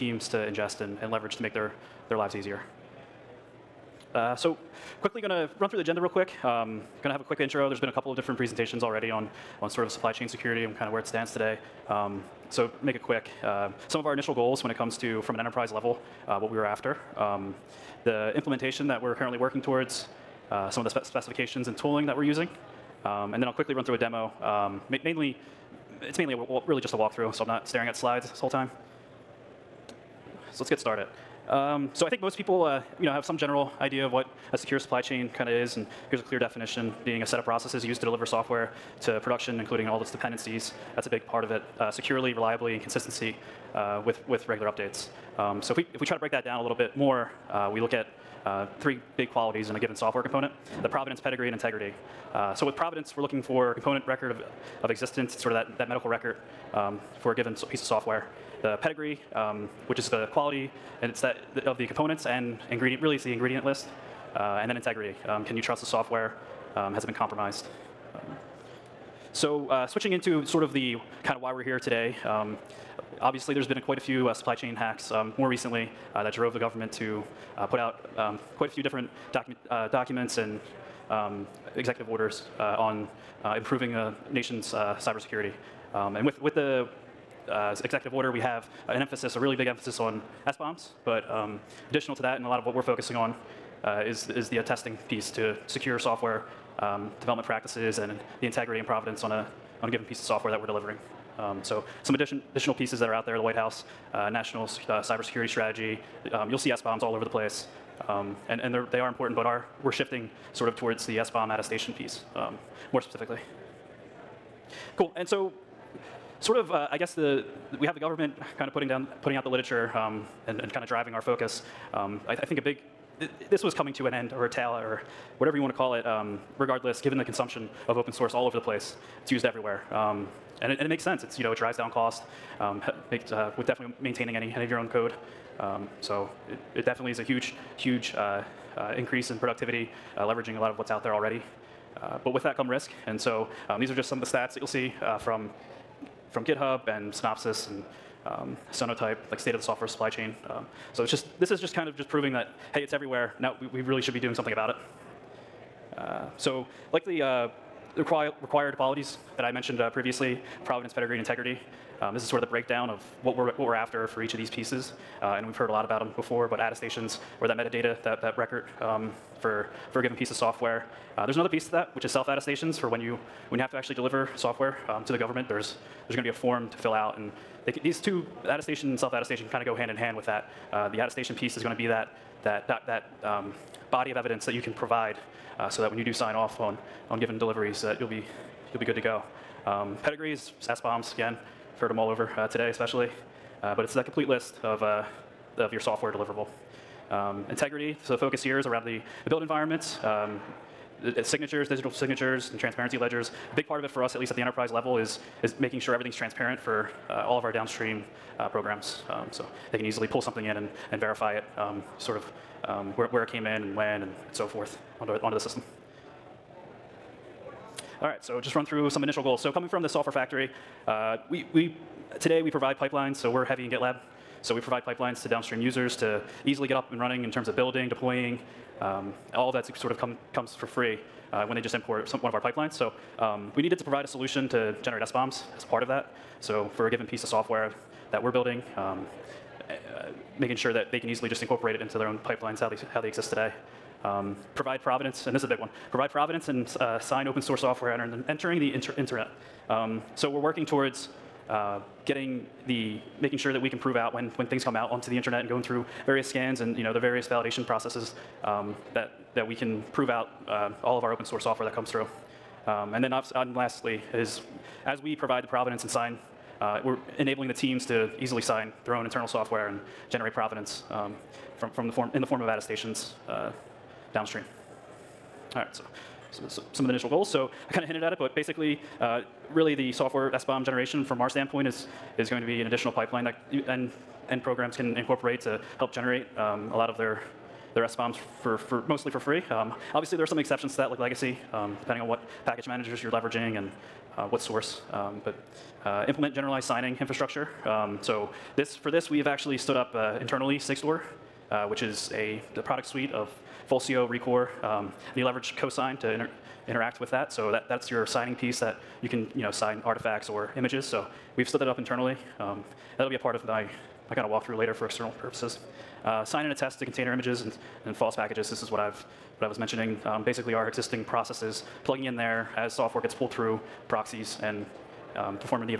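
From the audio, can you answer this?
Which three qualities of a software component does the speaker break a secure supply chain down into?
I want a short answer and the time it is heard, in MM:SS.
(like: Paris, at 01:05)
Provenance, pedigree, and integrity, at 00:50.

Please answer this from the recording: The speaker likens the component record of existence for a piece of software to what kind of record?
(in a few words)
Medical record.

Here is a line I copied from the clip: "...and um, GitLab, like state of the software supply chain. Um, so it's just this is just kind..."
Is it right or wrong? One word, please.
wrong.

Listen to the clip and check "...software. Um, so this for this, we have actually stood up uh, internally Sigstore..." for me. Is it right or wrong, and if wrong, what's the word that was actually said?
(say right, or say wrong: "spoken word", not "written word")
wrong: "infrastructure", not "software".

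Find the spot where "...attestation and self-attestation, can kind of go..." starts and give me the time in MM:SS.
02:58.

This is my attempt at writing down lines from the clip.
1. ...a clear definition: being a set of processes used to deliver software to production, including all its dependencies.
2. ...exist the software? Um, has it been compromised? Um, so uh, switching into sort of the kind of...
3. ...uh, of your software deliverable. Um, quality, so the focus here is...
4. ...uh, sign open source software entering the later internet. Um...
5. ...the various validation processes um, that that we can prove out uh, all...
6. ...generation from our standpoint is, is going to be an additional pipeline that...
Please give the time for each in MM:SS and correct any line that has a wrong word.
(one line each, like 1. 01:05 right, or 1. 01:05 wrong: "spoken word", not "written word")
1. 00:36 right
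2. 01:05 wrong: "trust", not "exist"
3. 03:14 wrong: "integrity", not "quality"
4. 04:06 wrong: "inter", not "later"
5. 04:16 right
6. 04:40 right.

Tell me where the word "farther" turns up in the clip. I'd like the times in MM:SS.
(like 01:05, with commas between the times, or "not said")
not said.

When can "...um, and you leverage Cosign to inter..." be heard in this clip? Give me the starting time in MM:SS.
05:04.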